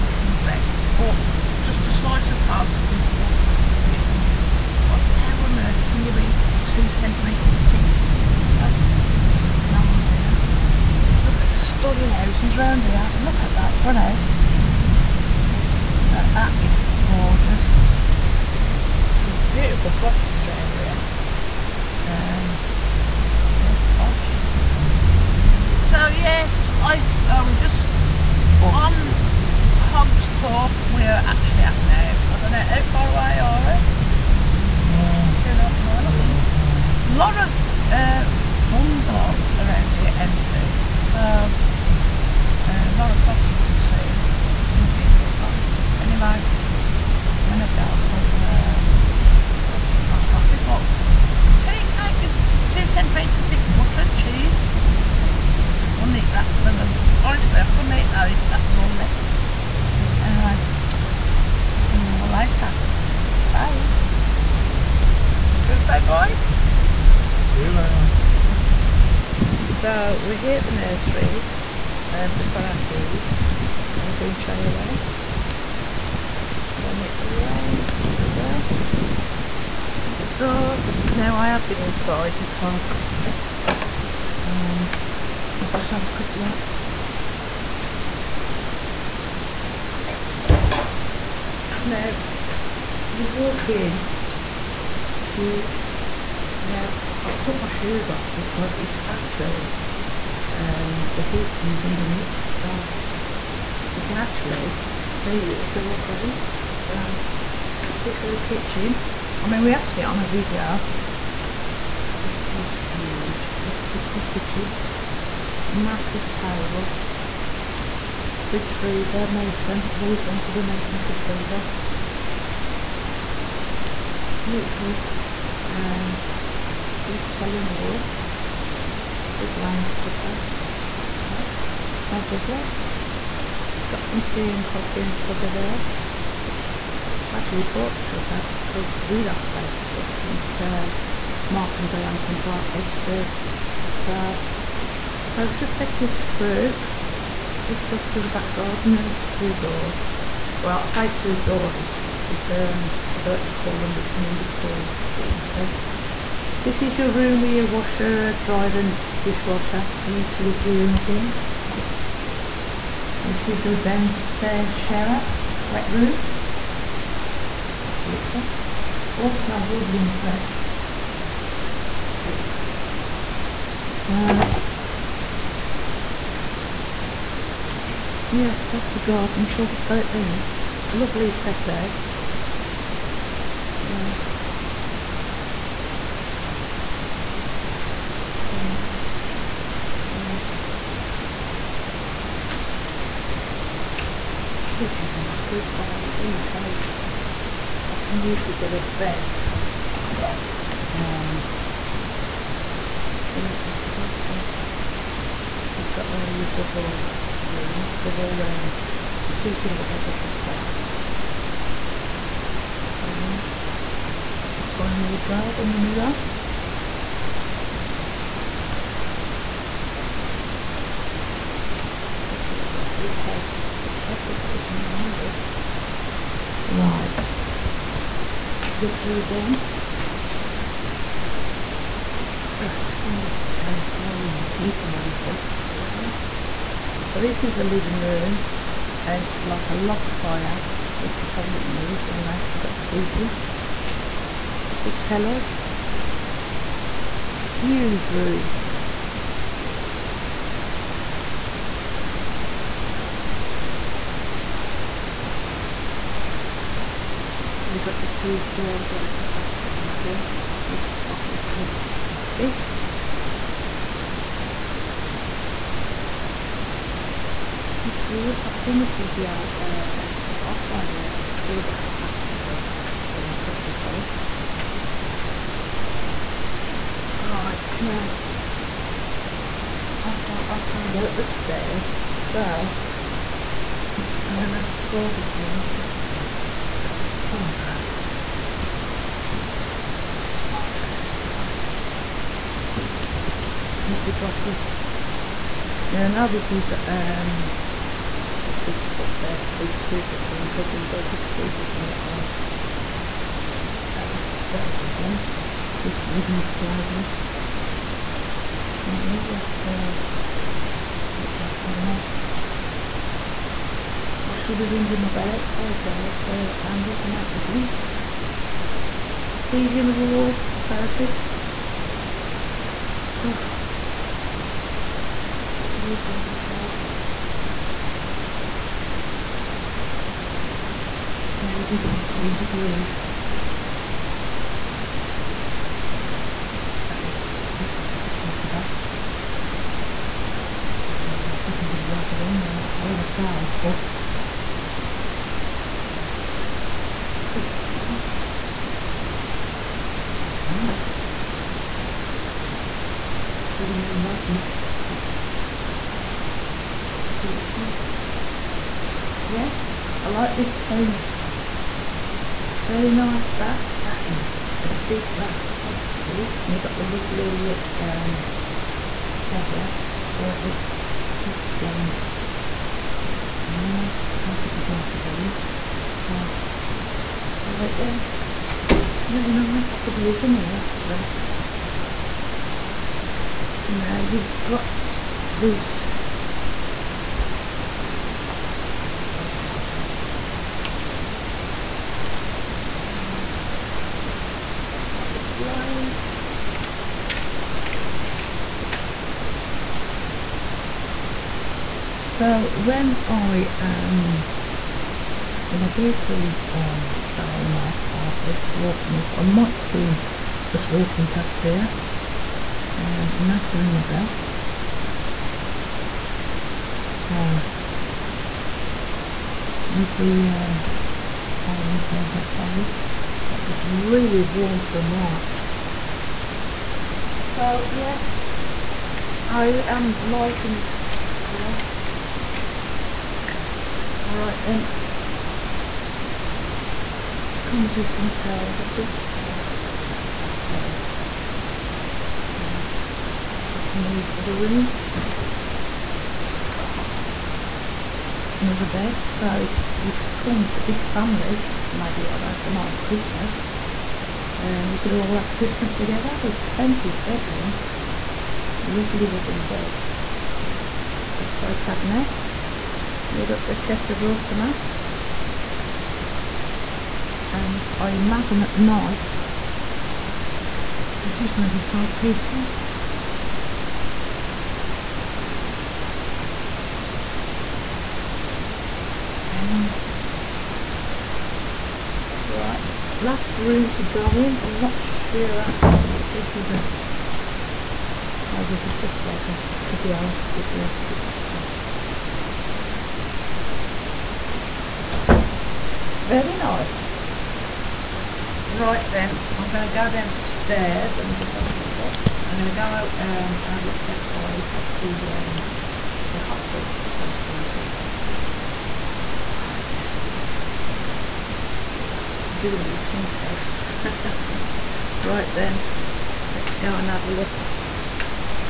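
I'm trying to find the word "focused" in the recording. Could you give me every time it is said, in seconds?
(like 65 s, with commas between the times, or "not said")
not said.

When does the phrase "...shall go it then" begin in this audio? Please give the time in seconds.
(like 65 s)
179 s.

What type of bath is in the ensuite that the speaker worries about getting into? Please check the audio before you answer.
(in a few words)
jacuzzi.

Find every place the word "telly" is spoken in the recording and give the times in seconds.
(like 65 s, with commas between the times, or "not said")
127 s, 245 s.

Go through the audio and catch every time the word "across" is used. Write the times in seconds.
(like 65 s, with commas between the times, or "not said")
not said.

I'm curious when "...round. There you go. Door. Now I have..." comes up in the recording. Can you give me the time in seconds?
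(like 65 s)
77 s.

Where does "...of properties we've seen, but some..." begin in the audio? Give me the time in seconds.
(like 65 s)
43 s.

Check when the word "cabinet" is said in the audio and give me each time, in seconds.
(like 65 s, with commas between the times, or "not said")
311 s, 461 s.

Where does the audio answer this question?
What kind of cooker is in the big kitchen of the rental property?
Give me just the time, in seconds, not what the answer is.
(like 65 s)
129 s.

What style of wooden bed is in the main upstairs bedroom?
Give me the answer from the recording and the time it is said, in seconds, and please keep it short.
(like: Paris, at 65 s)
sleigh bed, at 306 s.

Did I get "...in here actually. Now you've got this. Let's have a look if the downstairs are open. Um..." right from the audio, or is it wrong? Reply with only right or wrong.
wrong.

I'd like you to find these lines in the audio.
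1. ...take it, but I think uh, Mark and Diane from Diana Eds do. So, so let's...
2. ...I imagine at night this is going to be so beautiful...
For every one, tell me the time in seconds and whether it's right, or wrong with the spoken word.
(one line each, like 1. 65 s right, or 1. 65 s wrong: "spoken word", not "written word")
1. 139 s wrong: "Bart", not "Diana"
2. 467 s wrong: "peaceful", not "beautiful".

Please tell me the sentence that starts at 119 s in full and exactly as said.
I've always wanted American fridge freezer.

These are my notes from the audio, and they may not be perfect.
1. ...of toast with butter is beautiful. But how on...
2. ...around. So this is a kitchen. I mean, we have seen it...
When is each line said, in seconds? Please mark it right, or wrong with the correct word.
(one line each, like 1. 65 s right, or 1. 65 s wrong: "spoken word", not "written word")
1. 2 s right
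2. 106 s right.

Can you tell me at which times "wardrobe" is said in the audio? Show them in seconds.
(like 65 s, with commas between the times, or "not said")
214 s, 326 s.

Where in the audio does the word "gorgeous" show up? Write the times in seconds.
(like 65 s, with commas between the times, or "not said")
17 s, 337 s.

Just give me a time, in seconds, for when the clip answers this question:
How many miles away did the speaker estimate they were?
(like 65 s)
35 s.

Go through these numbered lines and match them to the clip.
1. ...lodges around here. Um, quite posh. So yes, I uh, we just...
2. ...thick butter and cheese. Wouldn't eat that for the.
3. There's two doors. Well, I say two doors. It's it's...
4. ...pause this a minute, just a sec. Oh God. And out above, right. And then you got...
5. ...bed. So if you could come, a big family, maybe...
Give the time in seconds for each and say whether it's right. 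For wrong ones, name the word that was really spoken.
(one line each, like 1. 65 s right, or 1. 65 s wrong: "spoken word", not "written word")
1. 19 s wrong: "properties", not "lodges"
2. 53 s right
3. 148 s right
4. 284 s right
5. 448 s right.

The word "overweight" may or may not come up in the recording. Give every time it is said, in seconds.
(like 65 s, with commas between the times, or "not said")
not said.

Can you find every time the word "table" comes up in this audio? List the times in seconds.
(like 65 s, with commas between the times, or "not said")
116 s, 421 s.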